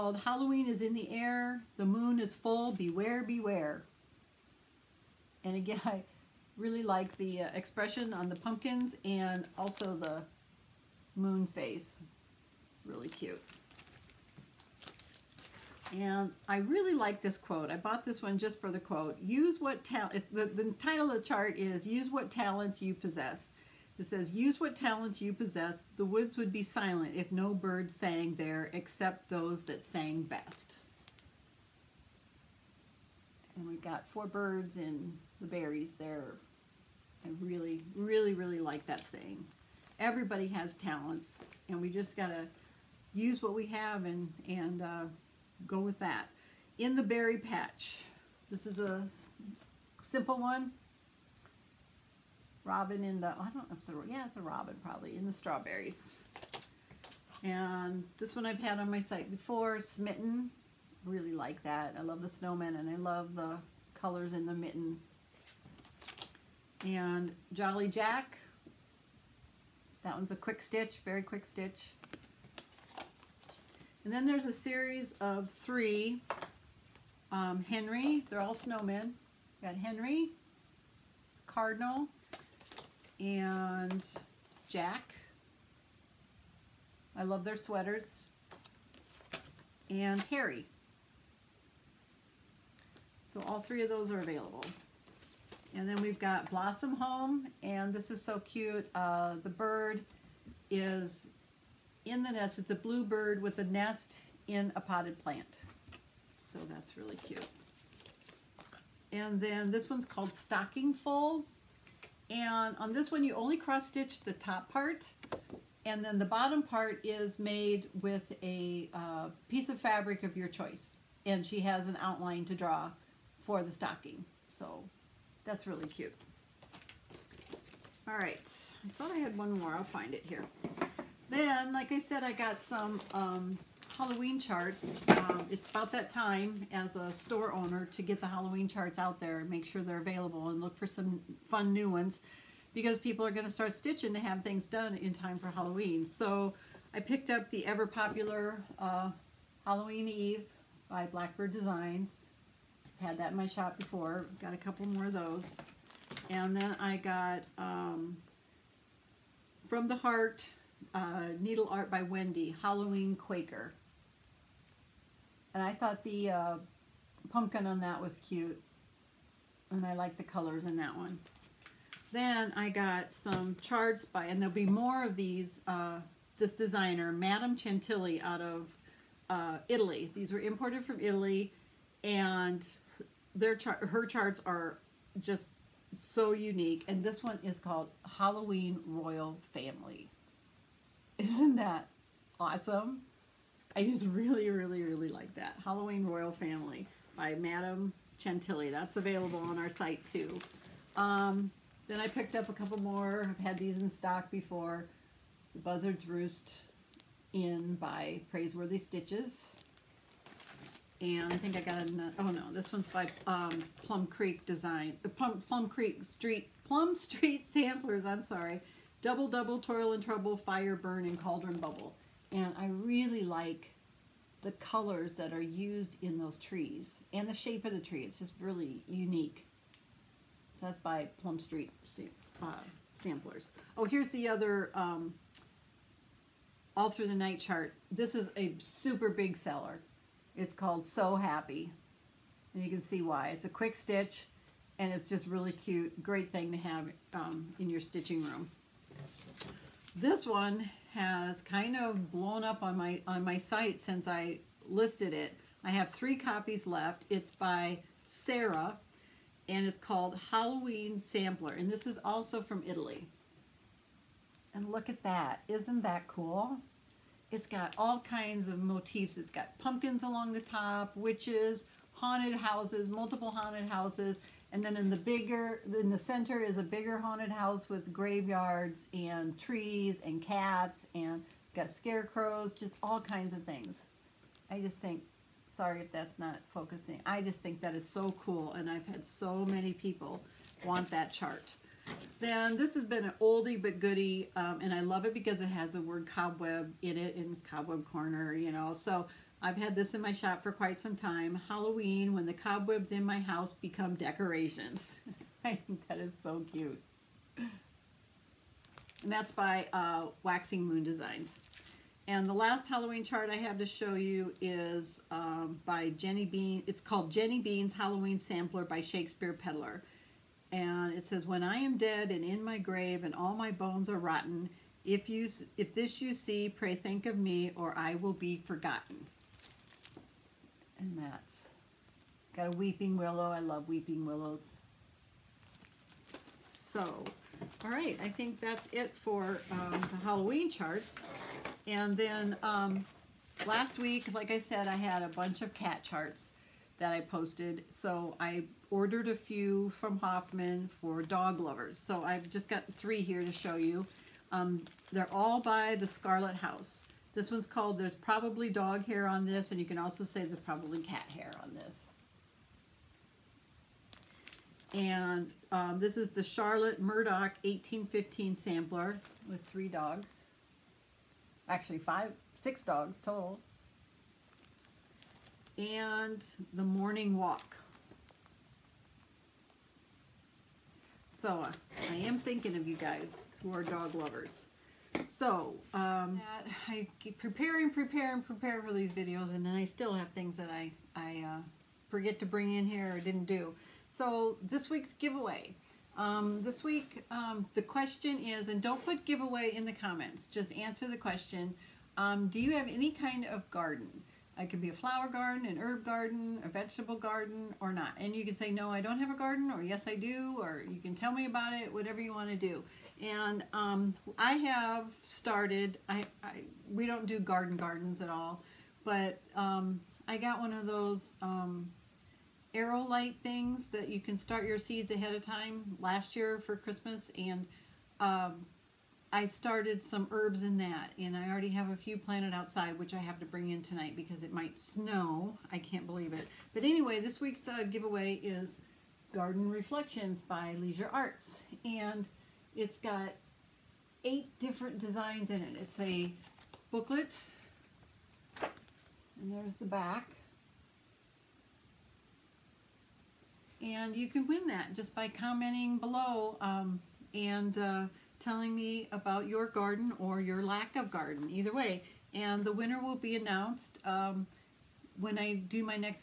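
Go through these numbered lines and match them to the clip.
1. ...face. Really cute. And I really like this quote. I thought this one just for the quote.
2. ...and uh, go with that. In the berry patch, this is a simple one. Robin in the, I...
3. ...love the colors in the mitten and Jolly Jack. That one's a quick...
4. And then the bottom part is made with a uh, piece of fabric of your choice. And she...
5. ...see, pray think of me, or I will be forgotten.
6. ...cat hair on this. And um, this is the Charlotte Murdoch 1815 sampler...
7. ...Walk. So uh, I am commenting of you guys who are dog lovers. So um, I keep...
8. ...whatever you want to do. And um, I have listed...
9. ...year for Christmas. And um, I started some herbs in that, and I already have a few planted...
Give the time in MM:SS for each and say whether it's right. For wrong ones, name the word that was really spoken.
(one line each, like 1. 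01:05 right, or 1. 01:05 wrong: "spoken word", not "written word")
1. 00:11 wrong: "bought", not "thought"
2. 00:44 right
3. 01:02 right
4. 01:55 right
5. 05:26 right
6. 06:00 right
7. 06:17 wrong: "thinking", not "commenting"
8. 06:51 wrong: "started", not "listed"
9. 07:06 right.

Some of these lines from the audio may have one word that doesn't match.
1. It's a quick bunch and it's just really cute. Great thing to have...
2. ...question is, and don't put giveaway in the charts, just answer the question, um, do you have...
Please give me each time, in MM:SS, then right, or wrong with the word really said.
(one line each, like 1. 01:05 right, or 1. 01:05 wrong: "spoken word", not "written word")
1. 04:03 wrong: "stitch", not "bunch"
2. 06:37 wrong: "comments", not "charts".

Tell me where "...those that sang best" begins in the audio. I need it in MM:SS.
00:29.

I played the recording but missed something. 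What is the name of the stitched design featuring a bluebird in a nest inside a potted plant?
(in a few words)
Blossom Home.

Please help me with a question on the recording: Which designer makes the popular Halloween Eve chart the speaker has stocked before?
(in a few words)
Blackbird Designs.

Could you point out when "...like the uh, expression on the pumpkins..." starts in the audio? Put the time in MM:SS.
00:06.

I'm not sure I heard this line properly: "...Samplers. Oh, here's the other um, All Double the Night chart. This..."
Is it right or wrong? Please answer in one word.
wrong.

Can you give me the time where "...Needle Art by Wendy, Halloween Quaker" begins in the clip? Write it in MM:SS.
02:41.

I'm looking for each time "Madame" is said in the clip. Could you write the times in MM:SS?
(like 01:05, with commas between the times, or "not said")
02:57, 03:17.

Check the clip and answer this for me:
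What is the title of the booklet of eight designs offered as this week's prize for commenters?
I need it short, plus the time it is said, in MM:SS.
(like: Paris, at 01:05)
Garden Reflections, at 07:19.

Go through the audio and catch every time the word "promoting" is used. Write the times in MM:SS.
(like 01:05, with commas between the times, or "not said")
not said.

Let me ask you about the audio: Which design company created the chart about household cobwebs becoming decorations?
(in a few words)
Waxing Moon Designs.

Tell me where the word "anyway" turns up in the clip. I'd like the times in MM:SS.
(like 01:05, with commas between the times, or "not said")
07:16.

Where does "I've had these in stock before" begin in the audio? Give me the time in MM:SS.
03:23.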